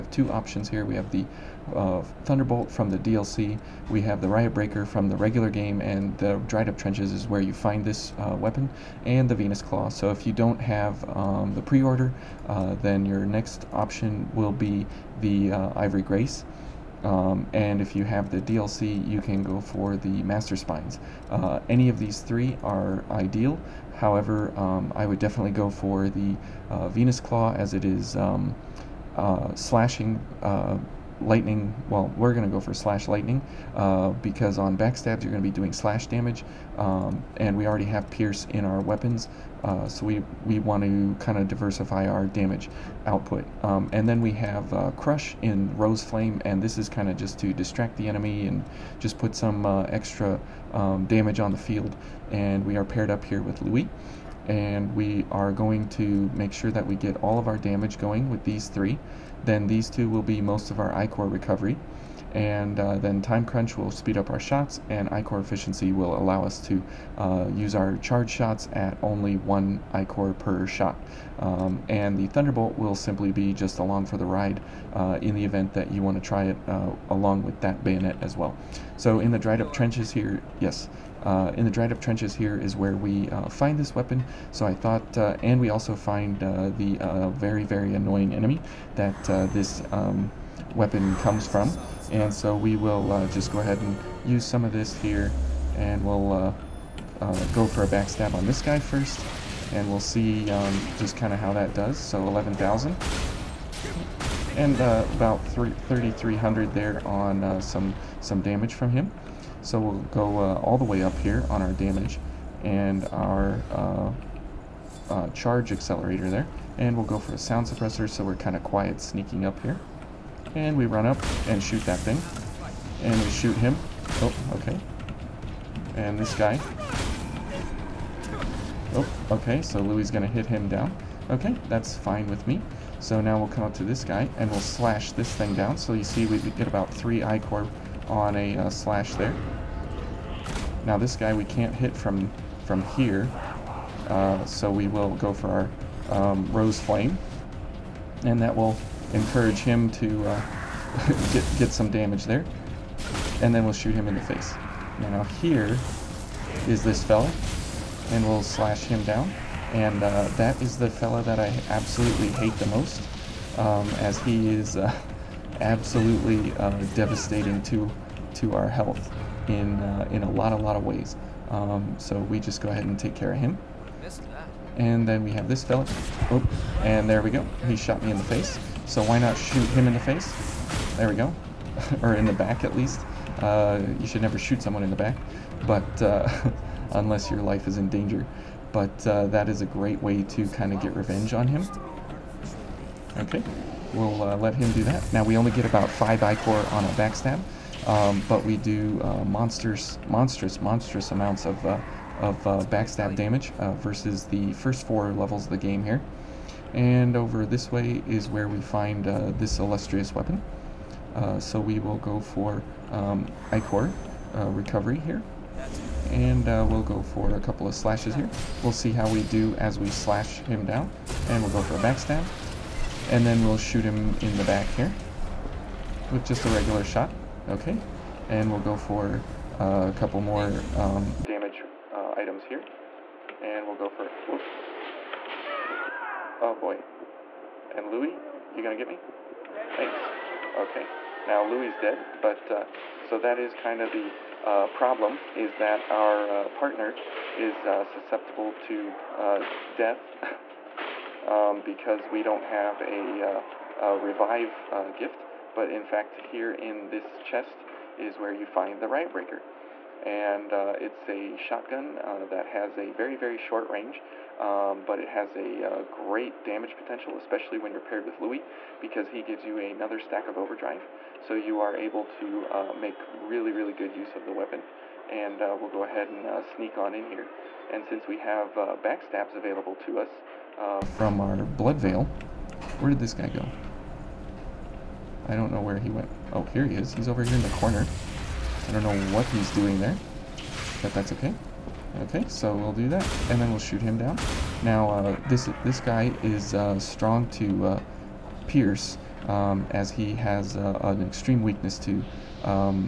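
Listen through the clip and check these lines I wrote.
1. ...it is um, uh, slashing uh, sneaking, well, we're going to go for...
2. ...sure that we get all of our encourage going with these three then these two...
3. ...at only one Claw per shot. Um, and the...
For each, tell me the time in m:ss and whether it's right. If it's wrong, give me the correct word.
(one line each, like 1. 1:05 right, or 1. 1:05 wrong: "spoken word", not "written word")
1. 0:27 wrong: "lightning", not "sneaking"
2. 0:56 wrong: "damage", not "encourage"
3. 1:08 wrong: "Ichor", not "Claw".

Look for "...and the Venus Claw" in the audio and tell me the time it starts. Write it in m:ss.
0:09.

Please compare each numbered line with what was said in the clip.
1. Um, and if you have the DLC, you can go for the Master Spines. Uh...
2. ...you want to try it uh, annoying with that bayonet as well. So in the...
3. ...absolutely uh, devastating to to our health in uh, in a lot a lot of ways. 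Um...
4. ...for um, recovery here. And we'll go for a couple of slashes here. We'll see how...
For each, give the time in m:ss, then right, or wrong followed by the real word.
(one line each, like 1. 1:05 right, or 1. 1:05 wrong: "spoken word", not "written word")
1. 0:17 right
2. 1:15 wrong: "along", not "annoying"
3. 2:45 right
4. 3:32 right.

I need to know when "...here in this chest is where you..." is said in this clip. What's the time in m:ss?
4:16.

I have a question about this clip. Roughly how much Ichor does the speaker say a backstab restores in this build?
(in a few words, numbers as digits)
5.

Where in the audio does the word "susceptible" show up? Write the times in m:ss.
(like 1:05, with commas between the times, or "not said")
4:07.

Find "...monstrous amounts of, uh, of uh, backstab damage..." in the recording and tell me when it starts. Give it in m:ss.
3:20.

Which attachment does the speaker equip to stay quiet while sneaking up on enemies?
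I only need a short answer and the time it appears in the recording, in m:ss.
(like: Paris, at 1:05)
Sound suppressor, at 1:57.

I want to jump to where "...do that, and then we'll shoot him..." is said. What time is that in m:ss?
4:52.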